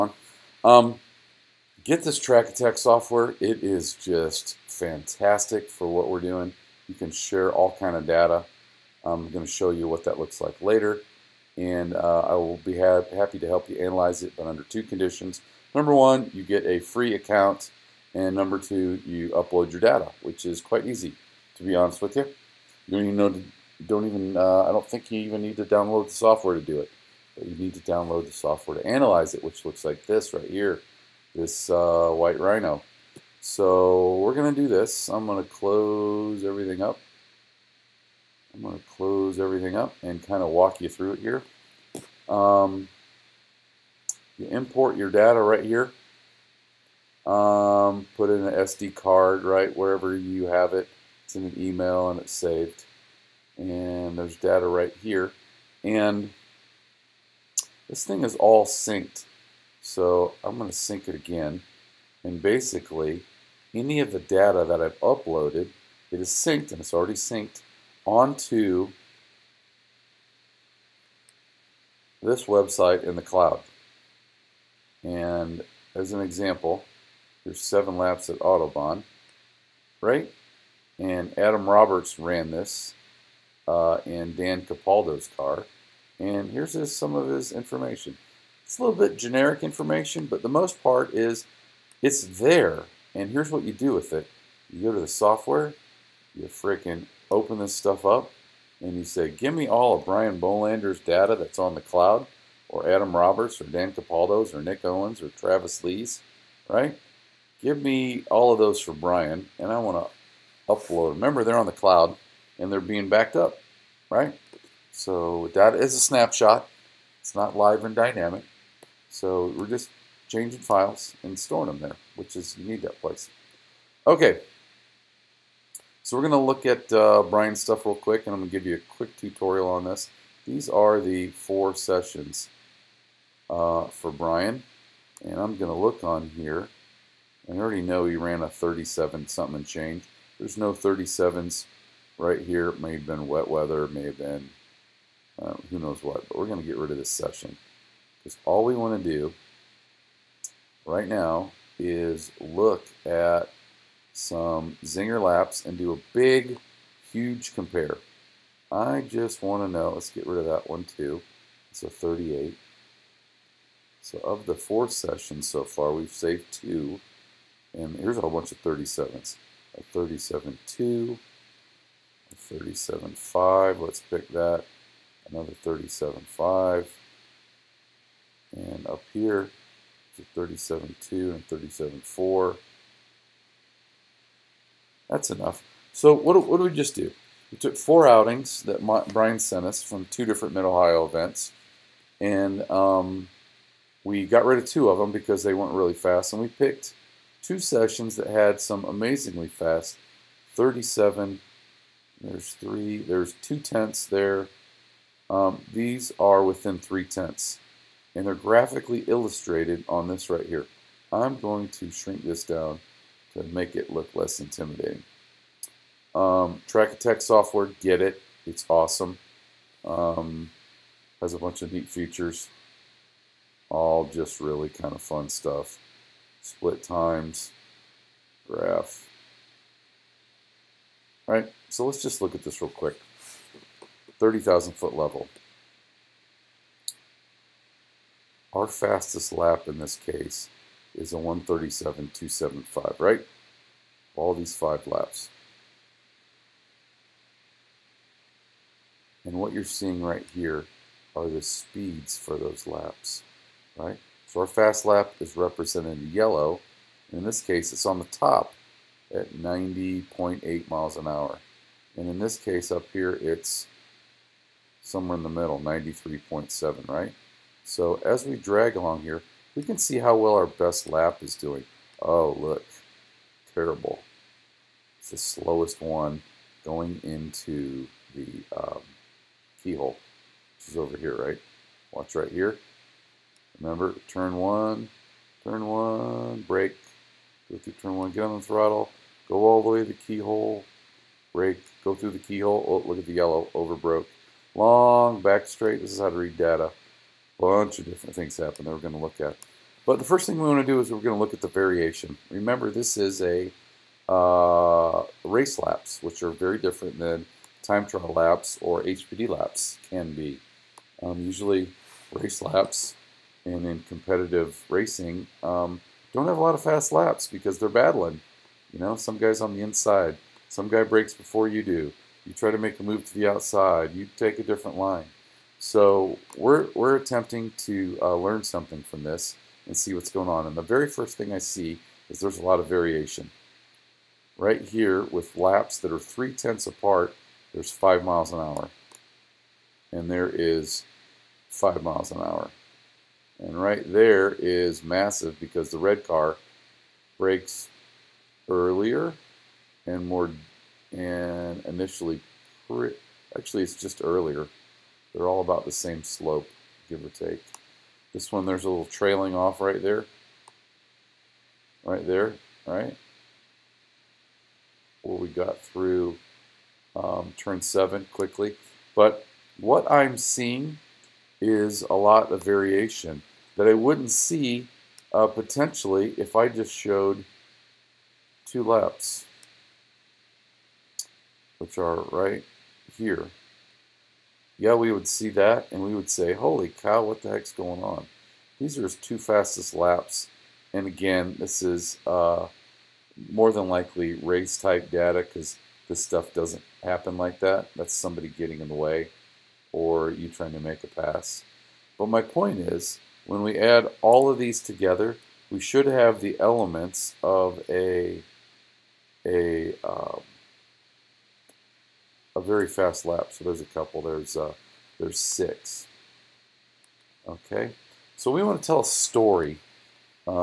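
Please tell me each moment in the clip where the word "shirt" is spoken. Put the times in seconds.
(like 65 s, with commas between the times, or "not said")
not said.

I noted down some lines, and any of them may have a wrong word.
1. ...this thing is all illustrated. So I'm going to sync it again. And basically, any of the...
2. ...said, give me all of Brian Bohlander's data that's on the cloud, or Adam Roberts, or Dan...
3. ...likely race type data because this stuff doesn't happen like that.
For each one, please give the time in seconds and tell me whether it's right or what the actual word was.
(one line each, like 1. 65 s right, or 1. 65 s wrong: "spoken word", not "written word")
1. 57 s wrong: "synced", not "illustrated"
2. 99 s right
3. 393 s right.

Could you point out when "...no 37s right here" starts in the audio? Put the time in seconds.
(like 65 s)
140 s.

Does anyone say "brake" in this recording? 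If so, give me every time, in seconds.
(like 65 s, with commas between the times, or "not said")
286 s, 291 s, 347 s.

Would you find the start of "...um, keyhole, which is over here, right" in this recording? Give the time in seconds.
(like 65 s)
278 s.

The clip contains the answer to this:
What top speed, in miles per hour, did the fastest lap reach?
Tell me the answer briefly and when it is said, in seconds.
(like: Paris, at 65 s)
90.8 mph, at 259 s.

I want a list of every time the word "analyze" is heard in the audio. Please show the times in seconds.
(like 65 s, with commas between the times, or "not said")
13 s, 28 s.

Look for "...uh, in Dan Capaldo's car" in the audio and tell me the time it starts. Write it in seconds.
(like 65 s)
83 s.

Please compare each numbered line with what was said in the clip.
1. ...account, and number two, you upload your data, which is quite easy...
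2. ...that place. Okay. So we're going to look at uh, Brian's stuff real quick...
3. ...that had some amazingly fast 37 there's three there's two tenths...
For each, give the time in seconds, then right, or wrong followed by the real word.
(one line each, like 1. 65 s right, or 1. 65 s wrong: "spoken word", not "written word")
1. 17 s right
2. 122 s right
3. 198 s right.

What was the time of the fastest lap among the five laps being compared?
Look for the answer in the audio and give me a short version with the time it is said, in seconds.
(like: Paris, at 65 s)
1:37.275, at 241 s.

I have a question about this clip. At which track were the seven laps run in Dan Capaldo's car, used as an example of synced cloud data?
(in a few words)
Autobahn.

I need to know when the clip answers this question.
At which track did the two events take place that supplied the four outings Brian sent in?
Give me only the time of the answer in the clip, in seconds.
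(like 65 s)
190 s.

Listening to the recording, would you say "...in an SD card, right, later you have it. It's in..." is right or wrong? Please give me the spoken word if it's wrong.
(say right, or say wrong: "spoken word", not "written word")
wrong: "wherever", not "later".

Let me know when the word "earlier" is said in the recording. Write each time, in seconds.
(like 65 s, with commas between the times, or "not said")
348 s, 354 s.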